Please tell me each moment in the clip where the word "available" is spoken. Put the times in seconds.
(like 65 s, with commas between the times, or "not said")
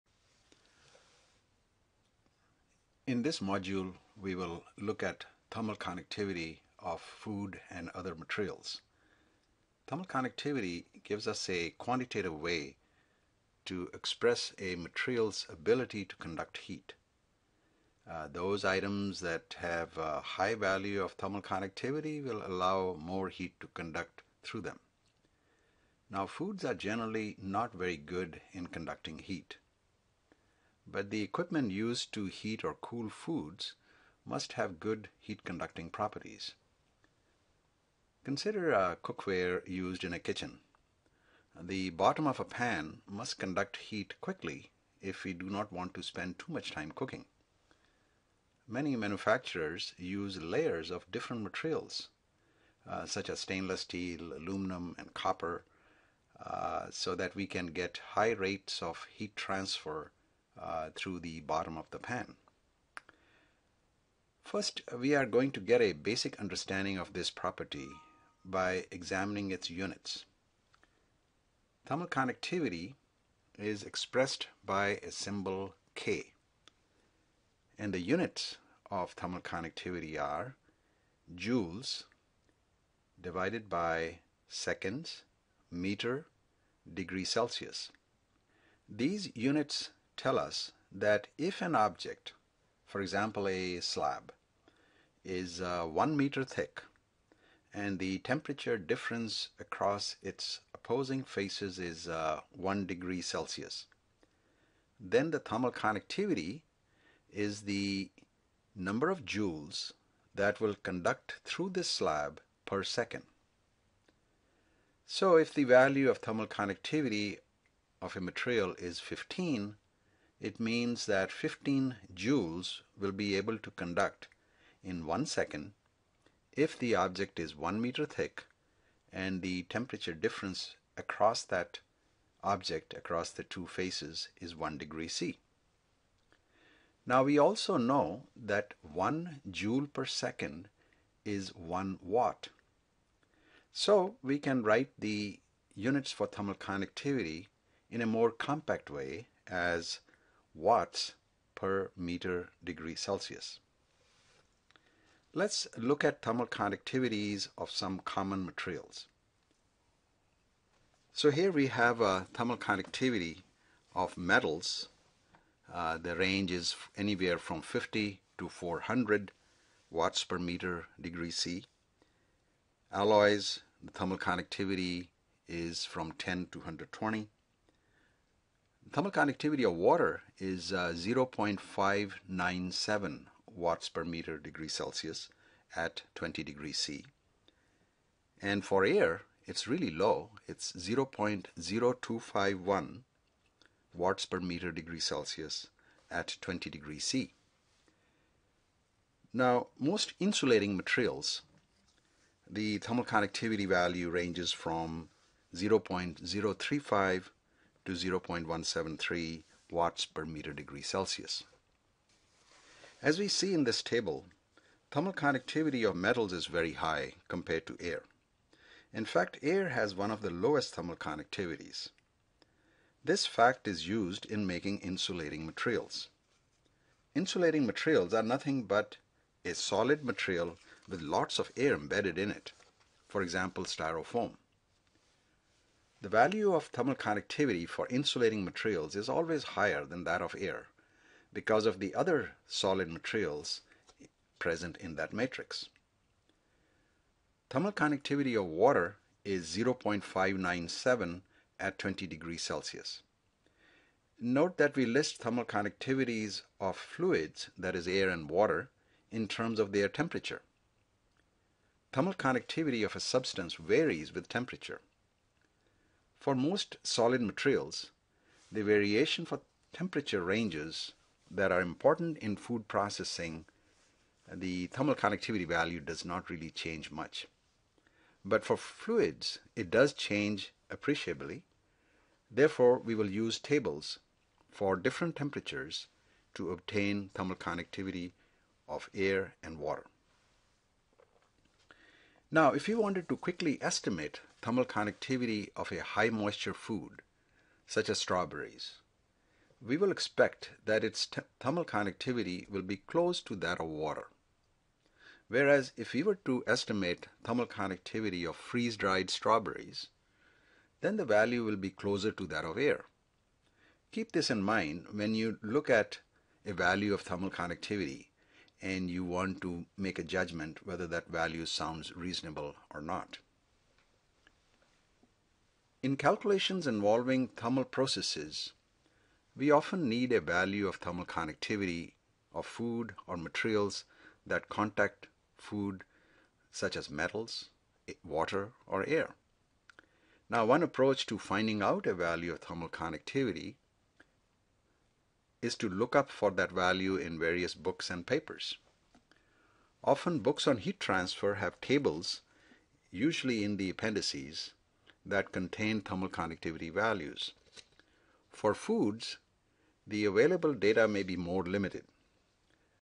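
360 s.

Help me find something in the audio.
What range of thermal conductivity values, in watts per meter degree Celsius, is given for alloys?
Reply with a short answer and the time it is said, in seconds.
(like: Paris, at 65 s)
10 to 120, at 176 s.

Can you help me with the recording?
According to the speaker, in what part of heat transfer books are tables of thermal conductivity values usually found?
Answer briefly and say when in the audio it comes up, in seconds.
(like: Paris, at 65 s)
appendices, at 353 s.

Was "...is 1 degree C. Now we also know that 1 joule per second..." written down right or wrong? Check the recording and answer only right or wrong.
right.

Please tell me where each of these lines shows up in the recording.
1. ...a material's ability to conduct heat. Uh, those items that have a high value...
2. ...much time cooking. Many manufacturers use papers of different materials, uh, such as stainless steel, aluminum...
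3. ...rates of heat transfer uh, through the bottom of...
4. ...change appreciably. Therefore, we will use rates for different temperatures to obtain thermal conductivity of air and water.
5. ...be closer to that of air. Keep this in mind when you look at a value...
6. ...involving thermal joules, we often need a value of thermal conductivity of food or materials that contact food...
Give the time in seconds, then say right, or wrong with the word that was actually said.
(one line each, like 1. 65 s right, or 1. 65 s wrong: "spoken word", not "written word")
1. 14 s right
2. 46 s wrong: "layers", not "papers"
3. 58 s right
4. 279 s wrong: "tables", not "rates"
5. 311 s right
6. 326 s wrong: "processes", not "joules".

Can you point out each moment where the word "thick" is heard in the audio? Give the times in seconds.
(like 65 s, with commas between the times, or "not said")
96 s, 128 s.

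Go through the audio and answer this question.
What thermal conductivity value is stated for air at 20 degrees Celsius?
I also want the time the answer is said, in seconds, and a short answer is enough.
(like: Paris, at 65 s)
0.0251, at 190 s.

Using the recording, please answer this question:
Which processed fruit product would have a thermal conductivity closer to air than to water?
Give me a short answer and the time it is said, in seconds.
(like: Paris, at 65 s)
freeze-dried strawberries, at 308 s.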